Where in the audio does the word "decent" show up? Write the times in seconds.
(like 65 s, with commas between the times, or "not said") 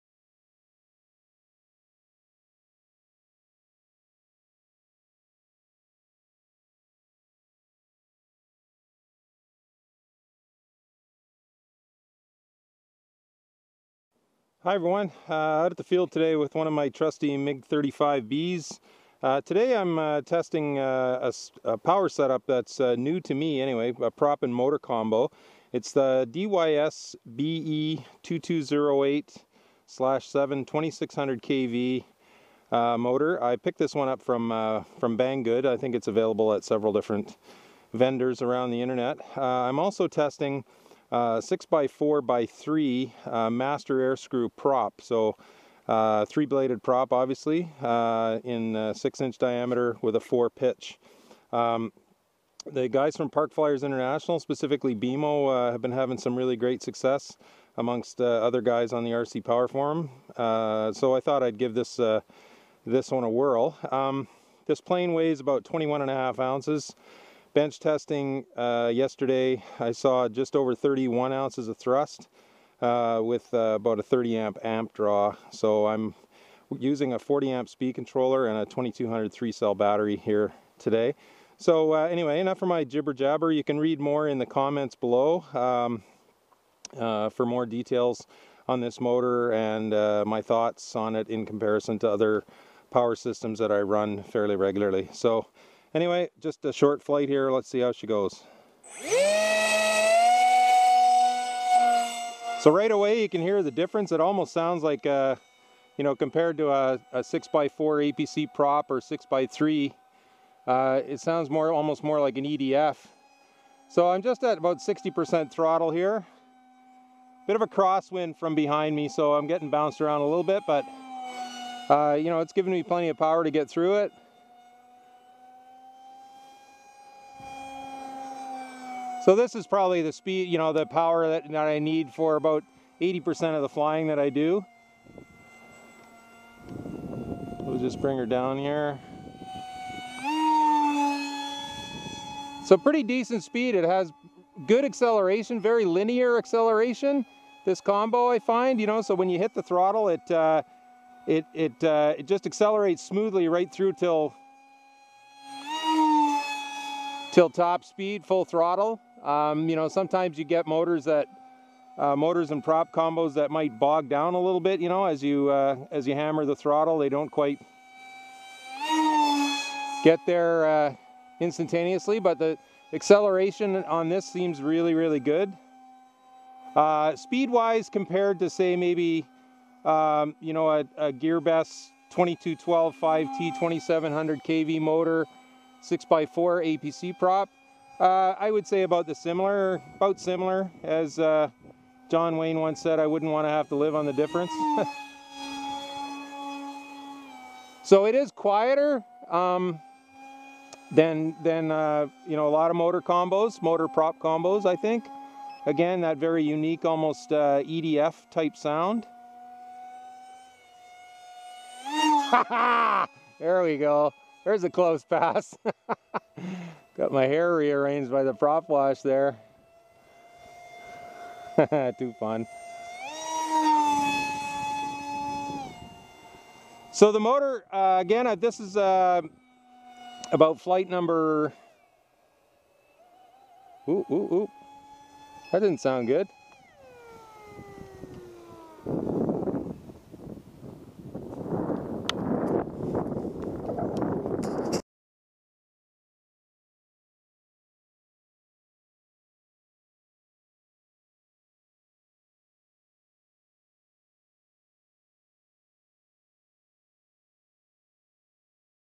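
143 s.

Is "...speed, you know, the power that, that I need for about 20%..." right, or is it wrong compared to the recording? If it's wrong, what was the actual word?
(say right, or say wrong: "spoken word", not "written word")
wrong: "80", not "20".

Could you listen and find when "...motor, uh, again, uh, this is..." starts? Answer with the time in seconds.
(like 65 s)
227 s.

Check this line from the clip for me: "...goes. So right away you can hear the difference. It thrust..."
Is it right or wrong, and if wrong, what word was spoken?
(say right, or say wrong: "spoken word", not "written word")
wrong: "almost", not "thrust".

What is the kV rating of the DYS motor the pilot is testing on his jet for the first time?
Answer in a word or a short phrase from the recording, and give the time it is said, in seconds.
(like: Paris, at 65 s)
2600 kV, at 30 s.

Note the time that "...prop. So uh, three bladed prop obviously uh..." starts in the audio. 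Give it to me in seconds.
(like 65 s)
44 s.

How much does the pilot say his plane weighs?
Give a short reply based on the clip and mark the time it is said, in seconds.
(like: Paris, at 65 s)
21.5 ounces, at 65 s.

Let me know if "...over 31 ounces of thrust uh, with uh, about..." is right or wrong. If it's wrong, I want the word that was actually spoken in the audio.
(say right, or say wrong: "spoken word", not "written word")
right.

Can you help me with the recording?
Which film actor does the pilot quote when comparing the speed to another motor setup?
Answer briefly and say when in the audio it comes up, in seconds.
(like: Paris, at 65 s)
John Wayne, at 192 s.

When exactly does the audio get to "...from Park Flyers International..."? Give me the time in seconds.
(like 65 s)
53 s.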